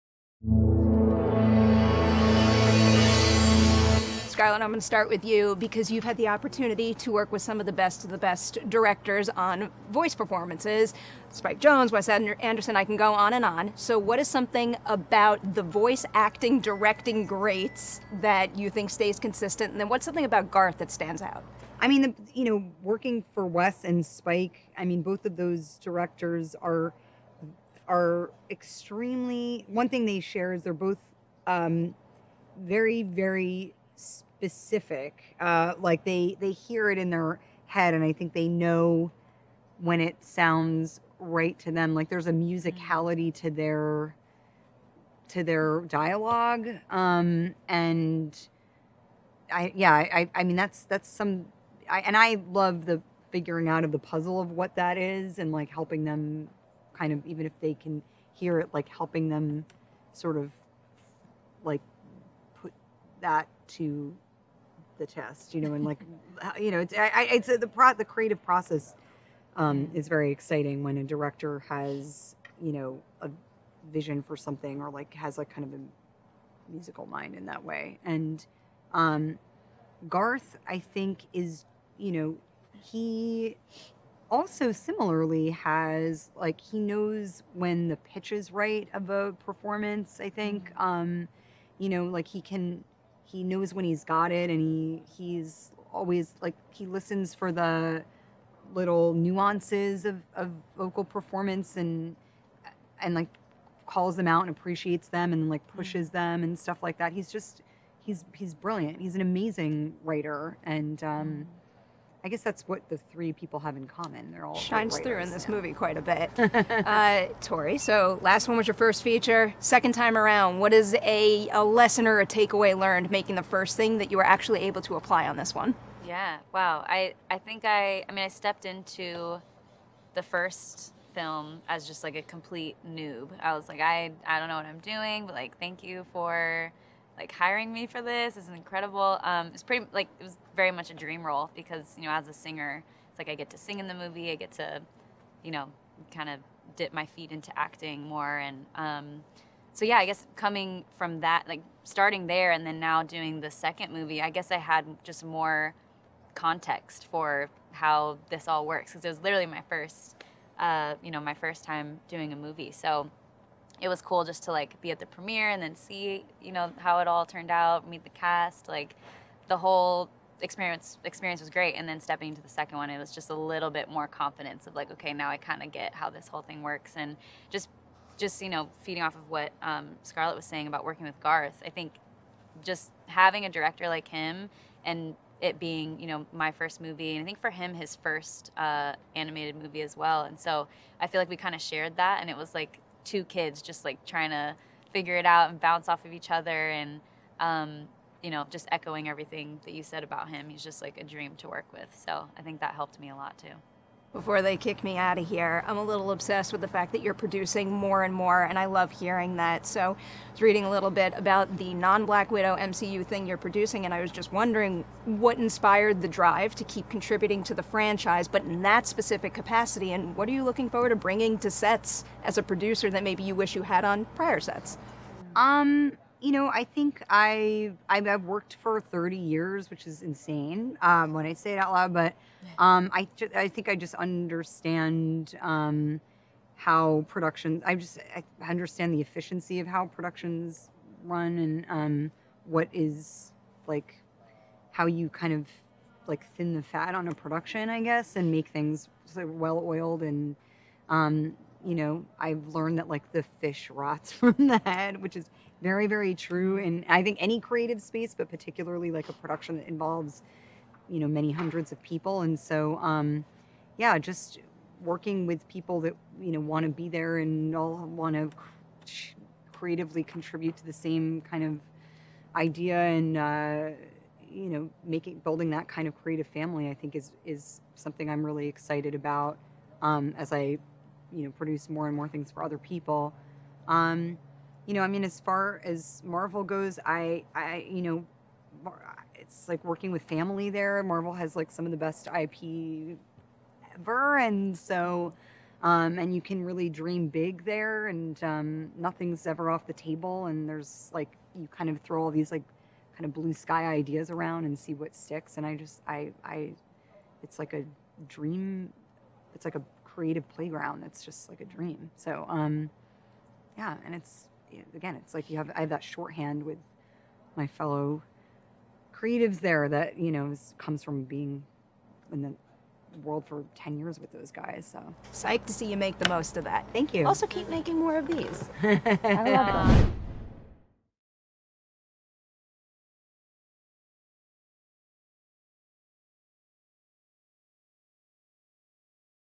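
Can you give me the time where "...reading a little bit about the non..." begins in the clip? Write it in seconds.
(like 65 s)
210 s.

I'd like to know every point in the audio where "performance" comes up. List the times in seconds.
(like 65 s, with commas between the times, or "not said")
10 s, 89 s, 101 s.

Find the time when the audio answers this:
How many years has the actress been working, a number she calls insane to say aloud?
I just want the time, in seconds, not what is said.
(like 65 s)
228 s.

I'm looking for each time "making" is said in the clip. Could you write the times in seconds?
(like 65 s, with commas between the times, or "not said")
123 s, 274 s, 327 s.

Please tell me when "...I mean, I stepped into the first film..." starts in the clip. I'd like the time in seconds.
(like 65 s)
128 s.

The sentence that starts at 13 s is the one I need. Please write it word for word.
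So, what is something about the voice acting, directing greats that you think stays consistent?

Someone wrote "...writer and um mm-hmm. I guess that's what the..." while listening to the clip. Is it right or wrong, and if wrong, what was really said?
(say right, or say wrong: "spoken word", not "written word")
right.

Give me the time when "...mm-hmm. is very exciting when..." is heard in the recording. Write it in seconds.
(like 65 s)
69 s.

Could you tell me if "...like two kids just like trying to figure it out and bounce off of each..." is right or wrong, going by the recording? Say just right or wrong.
right.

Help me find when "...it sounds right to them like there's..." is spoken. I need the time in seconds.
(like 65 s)
40 s.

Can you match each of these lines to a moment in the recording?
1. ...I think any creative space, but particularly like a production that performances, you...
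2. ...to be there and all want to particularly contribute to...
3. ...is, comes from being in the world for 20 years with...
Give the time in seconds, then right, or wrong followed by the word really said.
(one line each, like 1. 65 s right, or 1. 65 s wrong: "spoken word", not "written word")
1. 256 s wrong: "involves", not "performances"
2. 266 s wrong: "creatively", not "particularly"
3. 320 s wrong: "10", not "20".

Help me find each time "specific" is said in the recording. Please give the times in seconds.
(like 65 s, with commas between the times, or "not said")
33 s, 218 s.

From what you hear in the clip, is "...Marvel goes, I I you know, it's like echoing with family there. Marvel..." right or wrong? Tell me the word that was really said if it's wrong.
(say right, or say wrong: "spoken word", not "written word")
wrong: "working", not "echoing".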